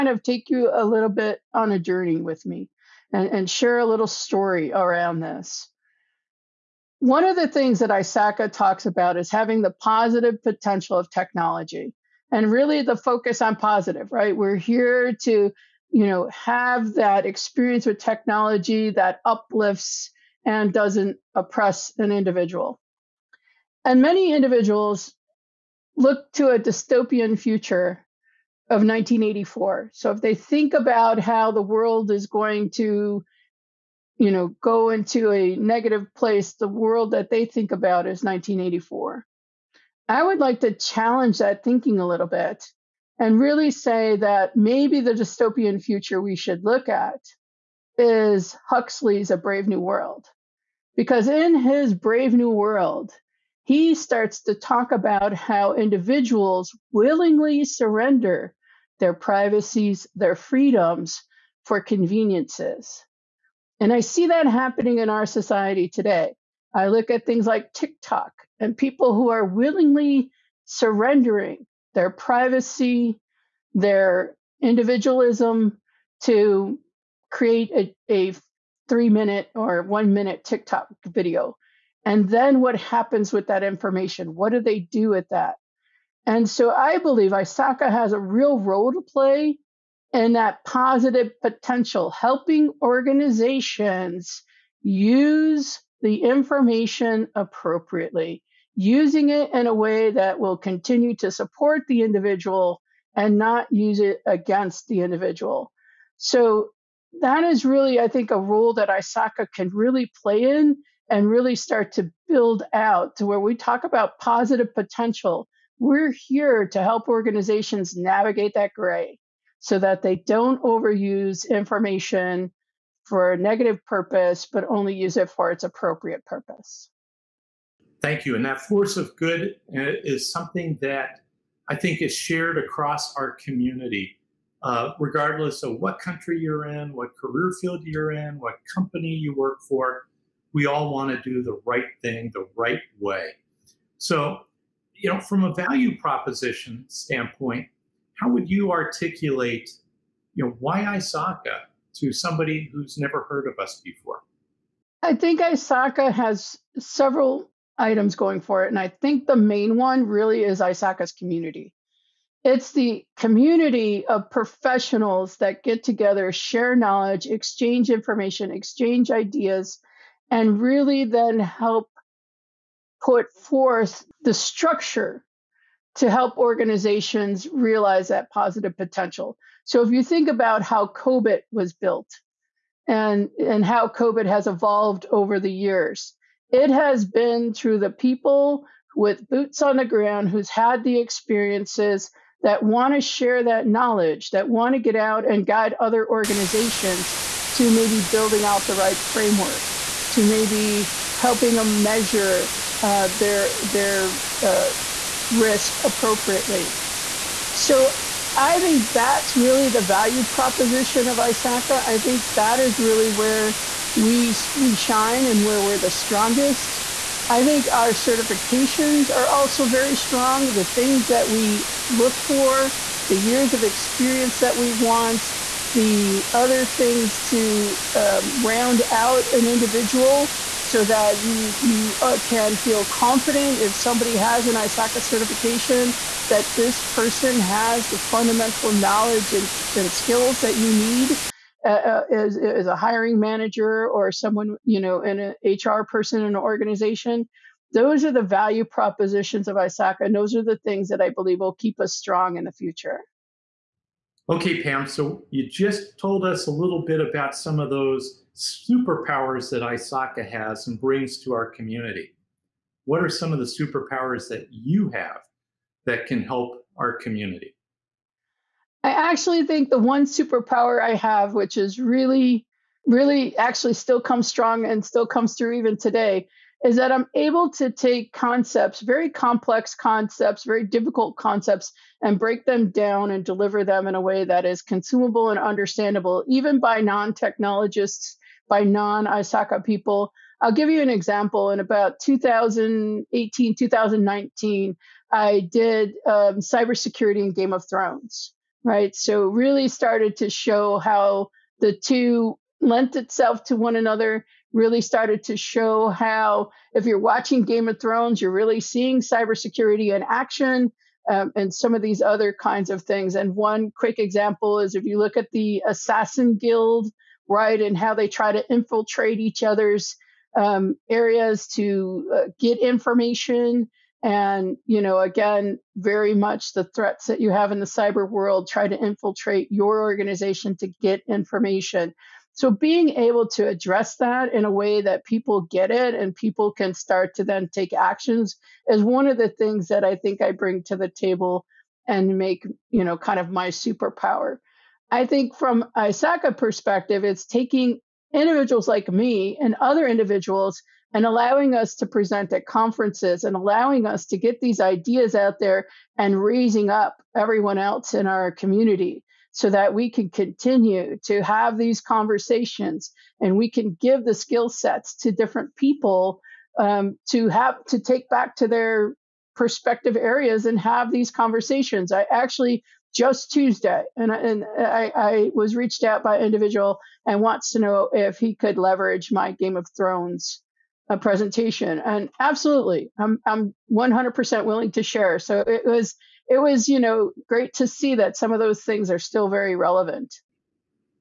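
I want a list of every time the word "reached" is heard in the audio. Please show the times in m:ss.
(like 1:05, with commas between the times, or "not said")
6:15.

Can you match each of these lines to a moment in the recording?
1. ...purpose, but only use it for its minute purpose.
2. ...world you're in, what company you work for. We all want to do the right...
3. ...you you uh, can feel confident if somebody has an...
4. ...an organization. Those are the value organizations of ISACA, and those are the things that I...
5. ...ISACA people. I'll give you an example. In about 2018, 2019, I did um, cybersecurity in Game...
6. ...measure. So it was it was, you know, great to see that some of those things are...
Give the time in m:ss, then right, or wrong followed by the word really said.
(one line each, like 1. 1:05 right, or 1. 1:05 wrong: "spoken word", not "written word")
1. 2:03 wrong: "appropriate", not "minute"
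2. 2:17 wrong: "field", not "world"
3. 3:51 right
4. 4:06 wrong: "propositions", not "organizations"
5. 4:49 right
6. 6:24 wrong: "share", not "measure".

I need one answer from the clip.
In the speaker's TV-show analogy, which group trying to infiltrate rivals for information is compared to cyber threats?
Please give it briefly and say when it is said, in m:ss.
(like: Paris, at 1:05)
Assassin Guild, at 5:15.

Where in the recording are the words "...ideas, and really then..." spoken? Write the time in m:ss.
2:49.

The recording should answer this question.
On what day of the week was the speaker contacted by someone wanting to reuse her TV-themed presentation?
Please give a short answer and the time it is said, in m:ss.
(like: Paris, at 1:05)
Tuesday, at 6:13.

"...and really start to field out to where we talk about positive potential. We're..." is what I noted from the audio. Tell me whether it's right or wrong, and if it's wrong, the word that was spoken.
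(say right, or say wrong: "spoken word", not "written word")
wrong: "build", not "field".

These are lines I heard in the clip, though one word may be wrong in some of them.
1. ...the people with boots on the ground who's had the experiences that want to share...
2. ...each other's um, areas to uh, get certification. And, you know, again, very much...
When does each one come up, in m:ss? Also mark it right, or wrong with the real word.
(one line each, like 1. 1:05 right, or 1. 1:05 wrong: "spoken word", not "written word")
1. 3:07 right
2. 5:19 wrong: "information", not "certification".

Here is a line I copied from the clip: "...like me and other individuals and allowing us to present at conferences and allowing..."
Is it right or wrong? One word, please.
right.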